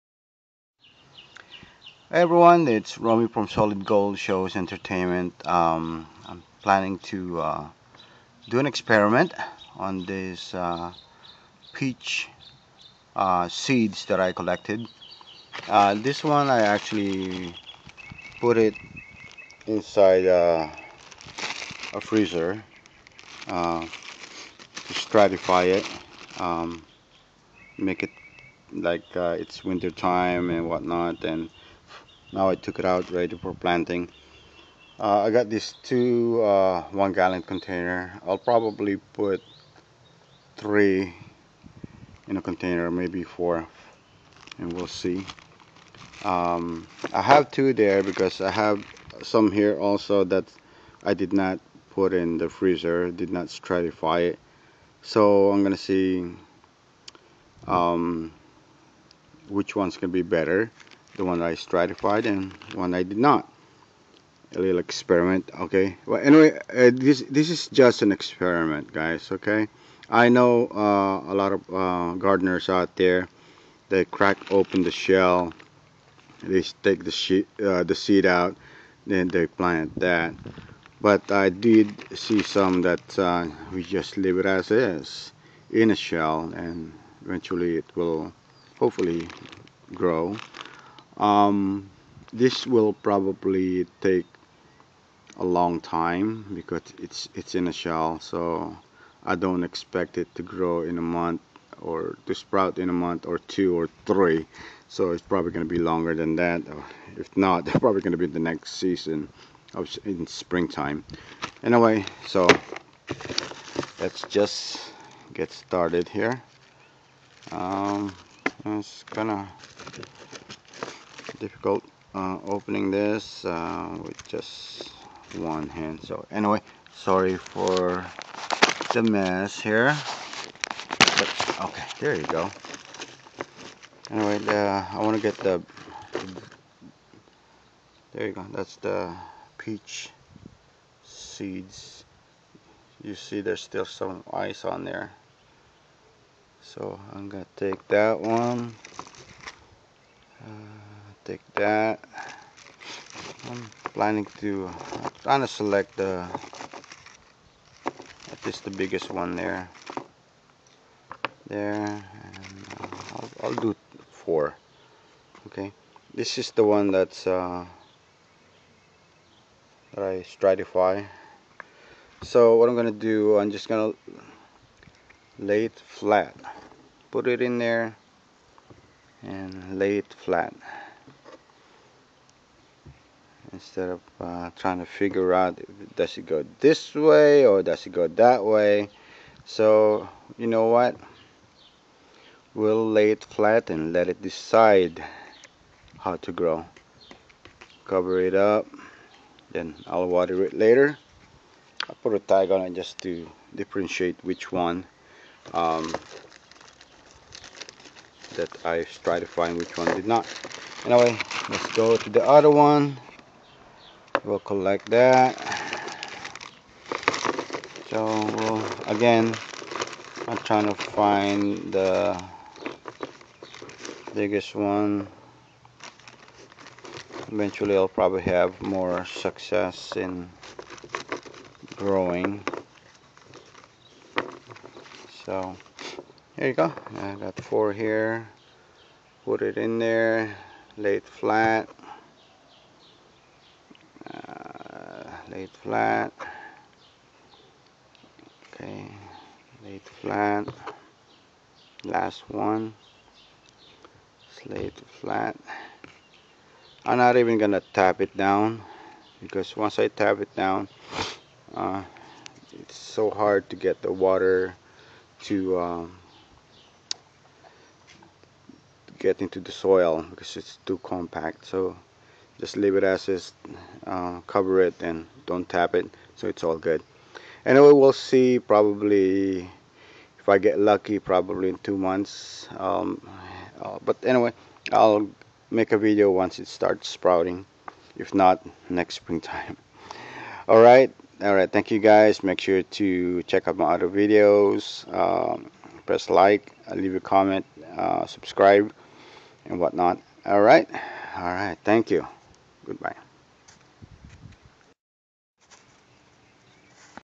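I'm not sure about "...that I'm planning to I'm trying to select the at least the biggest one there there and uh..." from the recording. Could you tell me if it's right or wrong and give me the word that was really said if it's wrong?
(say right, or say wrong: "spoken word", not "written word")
right.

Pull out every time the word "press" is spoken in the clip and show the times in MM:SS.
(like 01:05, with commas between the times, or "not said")
04:55.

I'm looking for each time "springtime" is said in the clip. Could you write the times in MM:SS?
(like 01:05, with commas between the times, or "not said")
01:50, 04:48.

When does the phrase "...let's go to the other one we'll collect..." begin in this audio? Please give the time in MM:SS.
03:31.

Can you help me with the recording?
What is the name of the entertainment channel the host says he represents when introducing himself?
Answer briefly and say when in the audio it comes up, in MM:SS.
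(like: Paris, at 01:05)
Solid Gold Shows Entertainment, at 00:03.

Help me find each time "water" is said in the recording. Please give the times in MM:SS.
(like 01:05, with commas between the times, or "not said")
03:20, 04:23.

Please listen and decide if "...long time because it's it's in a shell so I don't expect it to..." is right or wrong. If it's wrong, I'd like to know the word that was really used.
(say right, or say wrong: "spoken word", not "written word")
right.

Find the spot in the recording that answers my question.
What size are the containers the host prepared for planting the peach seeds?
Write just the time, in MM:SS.
00:36.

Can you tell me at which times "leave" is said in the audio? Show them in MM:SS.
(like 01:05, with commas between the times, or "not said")
01:24, 04:32, 04:56.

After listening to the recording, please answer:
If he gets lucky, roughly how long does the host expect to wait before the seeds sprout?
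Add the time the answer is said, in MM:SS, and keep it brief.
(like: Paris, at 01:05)
2 months, at 04:41.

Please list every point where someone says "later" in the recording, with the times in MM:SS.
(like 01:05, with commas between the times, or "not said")
03:20.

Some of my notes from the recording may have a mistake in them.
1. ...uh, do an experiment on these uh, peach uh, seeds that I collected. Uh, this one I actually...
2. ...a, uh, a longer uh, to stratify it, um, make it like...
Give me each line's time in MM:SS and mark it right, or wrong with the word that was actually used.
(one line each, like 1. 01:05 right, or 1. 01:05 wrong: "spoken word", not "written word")
1. 00:07 right
2. 00:20 wrong: "freezer", not "longer".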